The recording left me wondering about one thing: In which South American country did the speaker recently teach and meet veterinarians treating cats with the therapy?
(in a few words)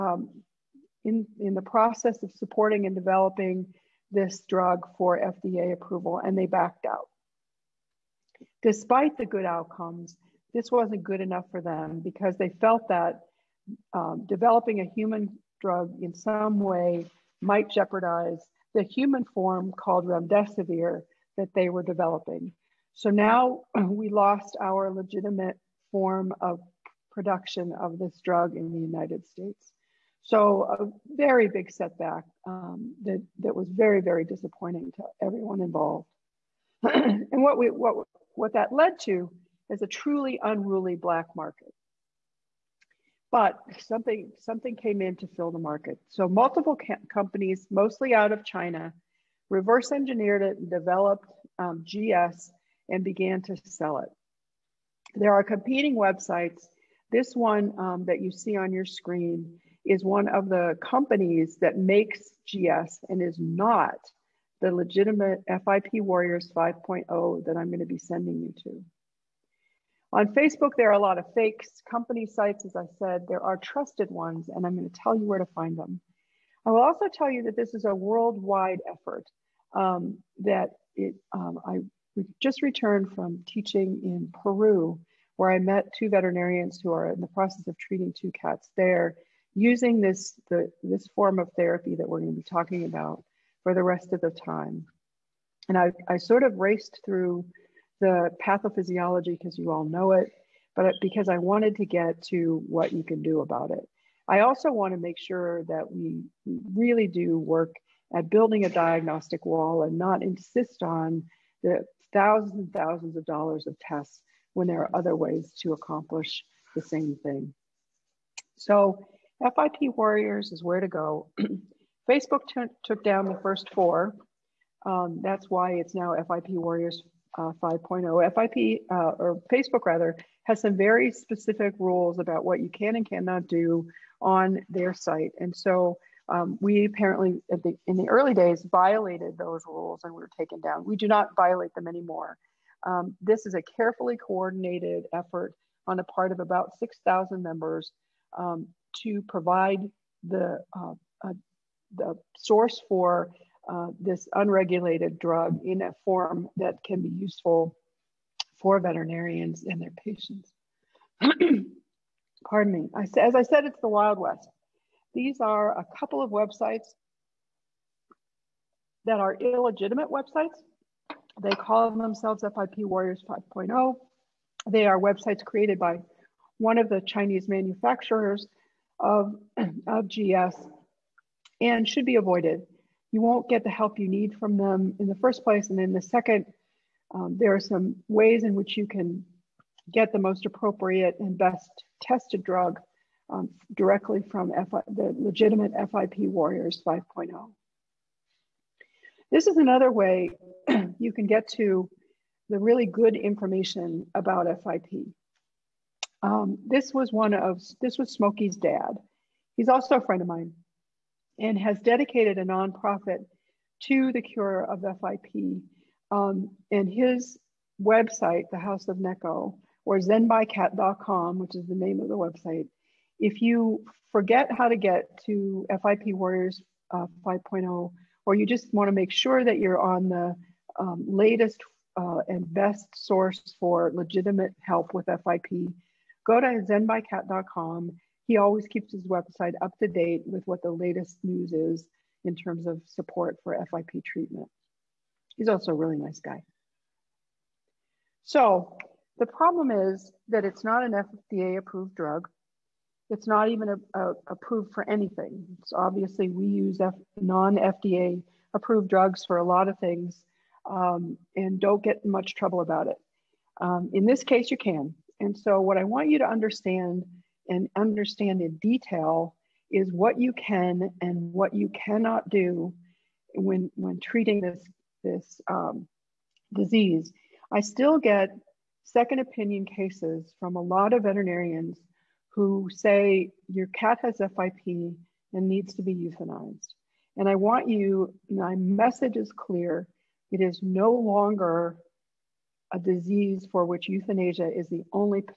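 Peru.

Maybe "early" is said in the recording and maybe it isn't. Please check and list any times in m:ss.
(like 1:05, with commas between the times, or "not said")
2:18.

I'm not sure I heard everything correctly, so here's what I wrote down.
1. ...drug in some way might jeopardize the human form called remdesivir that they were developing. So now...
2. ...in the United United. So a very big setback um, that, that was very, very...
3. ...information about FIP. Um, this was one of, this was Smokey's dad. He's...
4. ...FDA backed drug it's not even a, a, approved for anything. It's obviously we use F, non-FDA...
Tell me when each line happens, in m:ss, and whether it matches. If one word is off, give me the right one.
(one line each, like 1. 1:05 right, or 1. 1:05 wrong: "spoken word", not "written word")
1. 0:15 right
2. 0:28 wrong: "States", not "United"
3. 3:23 right
4. 4:10 wrong: "approved", not "backed".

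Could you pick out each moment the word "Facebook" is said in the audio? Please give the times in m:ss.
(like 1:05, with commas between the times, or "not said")
1:10, 2:02, 2:09.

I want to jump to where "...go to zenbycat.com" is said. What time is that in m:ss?
3:56.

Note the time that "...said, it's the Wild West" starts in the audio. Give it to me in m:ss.
2:43.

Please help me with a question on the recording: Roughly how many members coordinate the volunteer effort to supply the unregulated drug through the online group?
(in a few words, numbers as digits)
6,000.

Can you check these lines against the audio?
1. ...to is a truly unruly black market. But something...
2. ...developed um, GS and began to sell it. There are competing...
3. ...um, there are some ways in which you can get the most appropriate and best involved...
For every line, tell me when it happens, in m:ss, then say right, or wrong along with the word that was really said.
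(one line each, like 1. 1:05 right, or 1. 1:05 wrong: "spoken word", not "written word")
1. 0:39 right
2. 0:50 right
3. 3:07 wrong: "tested", not "involved".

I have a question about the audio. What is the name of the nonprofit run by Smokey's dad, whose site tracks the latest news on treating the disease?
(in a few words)
House of Neko.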